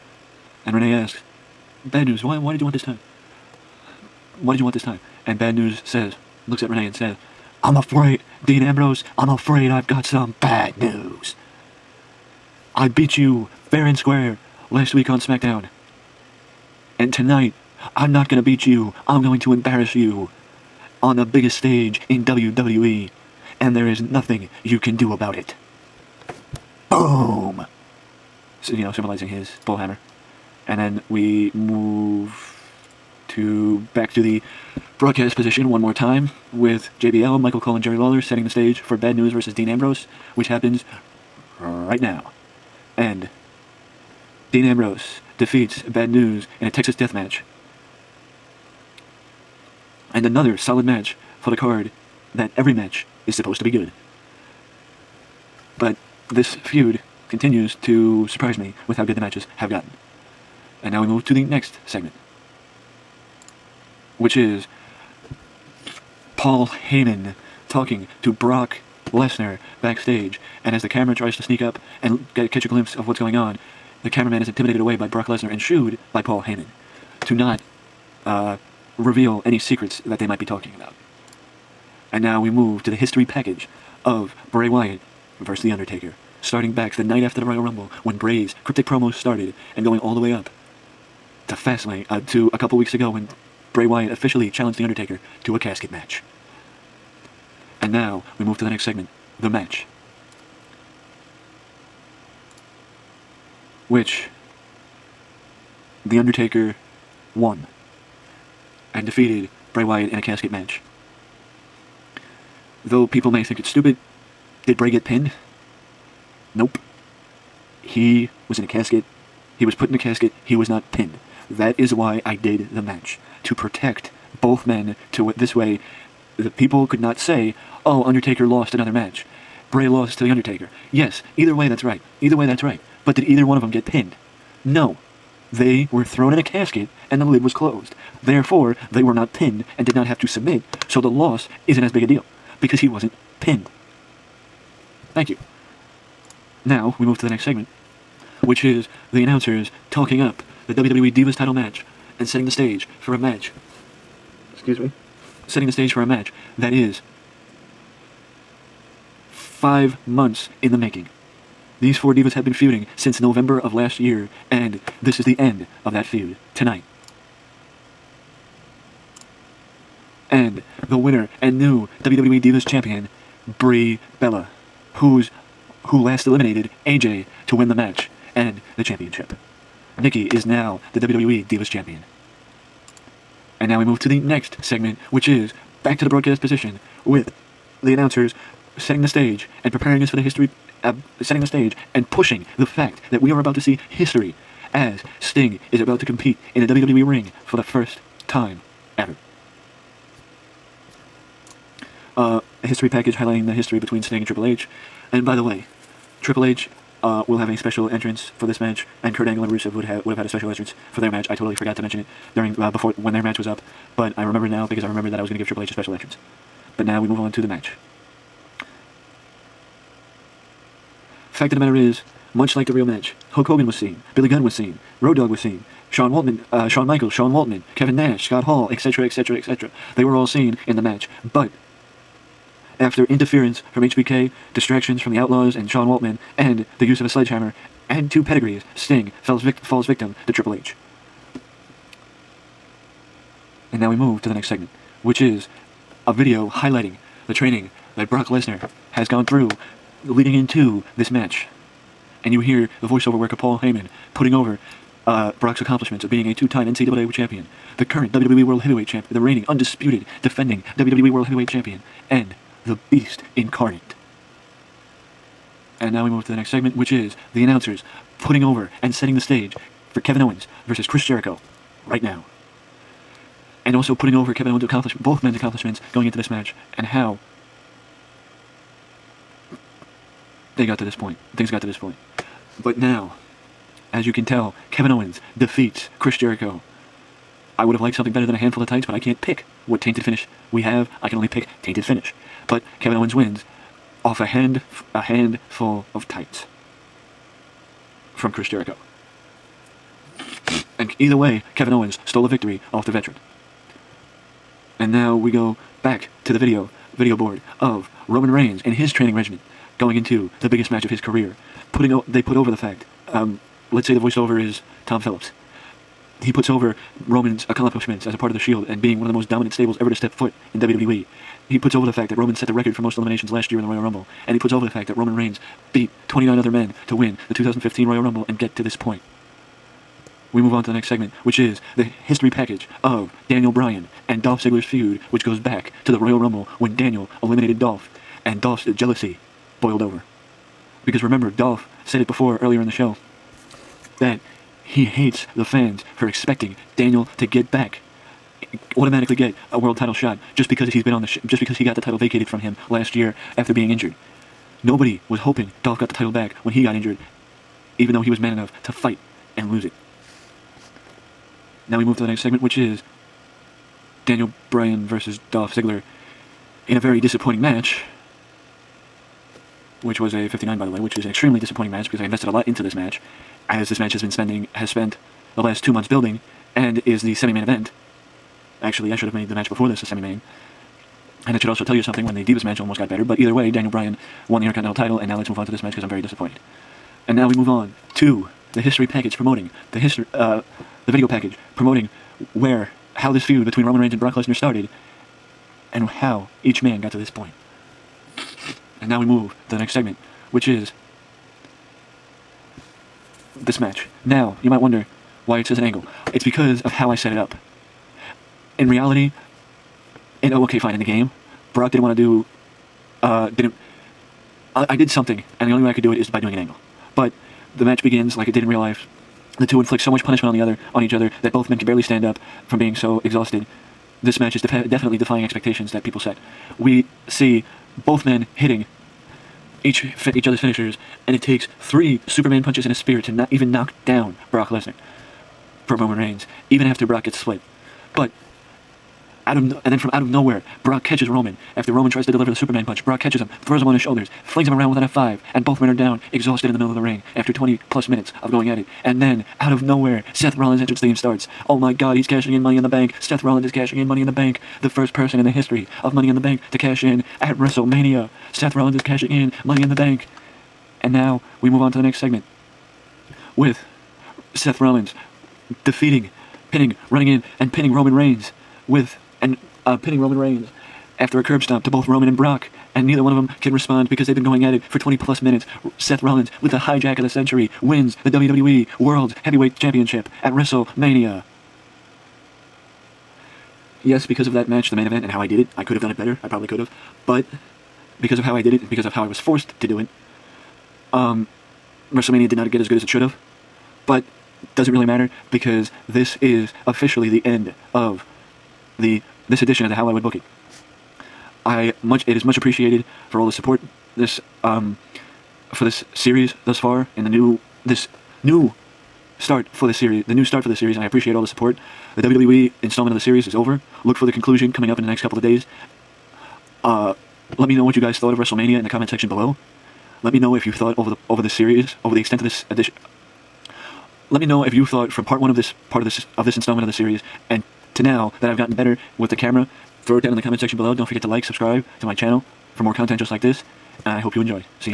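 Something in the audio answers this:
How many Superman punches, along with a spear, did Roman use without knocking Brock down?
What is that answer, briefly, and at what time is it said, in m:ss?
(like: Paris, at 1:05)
3, at 7:11.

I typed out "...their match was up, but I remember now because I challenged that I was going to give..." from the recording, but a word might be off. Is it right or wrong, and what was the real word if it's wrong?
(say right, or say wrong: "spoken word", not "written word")
wrong: "remembered", not "challenged".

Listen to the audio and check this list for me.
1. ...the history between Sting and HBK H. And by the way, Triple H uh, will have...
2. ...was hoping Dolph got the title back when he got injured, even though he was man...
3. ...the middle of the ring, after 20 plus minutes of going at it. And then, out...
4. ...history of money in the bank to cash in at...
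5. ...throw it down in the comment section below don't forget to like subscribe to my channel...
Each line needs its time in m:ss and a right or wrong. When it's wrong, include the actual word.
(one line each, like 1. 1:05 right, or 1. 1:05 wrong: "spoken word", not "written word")
1. 3:23 wrong: "Triple", not "HBK"
2. 5:55 right
3. 7:26 right
4. 7:35 right
5. 8:49 right.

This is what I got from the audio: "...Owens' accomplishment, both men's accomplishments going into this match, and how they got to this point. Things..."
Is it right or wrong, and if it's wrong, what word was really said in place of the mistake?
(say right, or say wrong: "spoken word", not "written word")
right.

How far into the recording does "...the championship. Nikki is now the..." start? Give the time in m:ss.
2:58.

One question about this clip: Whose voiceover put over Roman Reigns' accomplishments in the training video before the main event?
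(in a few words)
Tom Phillips.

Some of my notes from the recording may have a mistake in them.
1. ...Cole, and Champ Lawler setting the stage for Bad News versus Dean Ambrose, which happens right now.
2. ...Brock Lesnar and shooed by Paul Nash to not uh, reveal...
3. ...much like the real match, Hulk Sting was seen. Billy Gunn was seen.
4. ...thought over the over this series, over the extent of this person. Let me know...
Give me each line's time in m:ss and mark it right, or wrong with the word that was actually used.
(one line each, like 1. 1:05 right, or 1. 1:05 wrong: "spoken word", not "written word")
1. 0:37 wrong: "Jerry", not "Champ"
2. 1:15 wrong: "Heyman", not "Nash"
3. 3:42 wrong: "Hogan", not "Sting"
4. 8:40 wrong: "edition", not "person".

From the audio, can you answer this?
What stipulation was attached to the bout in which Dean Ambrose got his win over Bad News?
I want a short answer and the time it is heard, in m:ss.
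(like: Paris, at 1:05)
Texas death match, at 0:46.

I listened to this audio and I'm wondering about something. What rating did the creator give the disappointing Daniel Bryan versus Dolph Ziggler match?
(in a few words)
59.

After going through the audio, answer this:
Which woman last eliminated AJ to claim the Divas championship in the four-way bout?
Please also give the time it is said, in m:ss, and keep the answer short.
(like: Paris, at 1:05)
Brie Bella, at 2:53.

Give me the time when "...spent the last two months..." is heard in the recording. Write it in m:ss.
6:14.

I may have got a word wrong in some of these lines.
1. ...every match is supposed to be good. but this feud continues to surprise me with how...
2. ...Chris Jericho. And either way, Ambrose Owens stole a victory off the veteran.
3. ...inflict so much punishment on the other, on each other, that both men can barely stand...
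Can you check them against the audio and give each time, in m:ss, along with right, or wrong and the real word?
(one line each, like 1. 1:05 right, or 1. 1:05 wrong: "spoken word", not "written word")
1. 0:52 right
2. 4:58 wrong: "Kevin", not "Ambrose"
3. 6:59 right.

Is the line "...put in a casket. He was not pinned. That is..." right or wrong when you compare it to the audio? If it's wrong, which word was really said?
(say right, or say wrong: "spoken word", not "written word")
right.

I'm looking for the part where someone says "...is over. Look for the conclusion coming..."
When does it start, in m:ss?
8:33.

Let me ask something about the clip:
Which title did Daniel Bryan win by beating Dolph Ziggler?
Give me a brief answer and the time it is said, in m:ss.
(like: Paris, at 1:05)
Intercontinental title, at 6:24.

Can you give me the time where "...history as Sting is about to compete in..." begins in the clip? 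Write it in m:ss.
3:13.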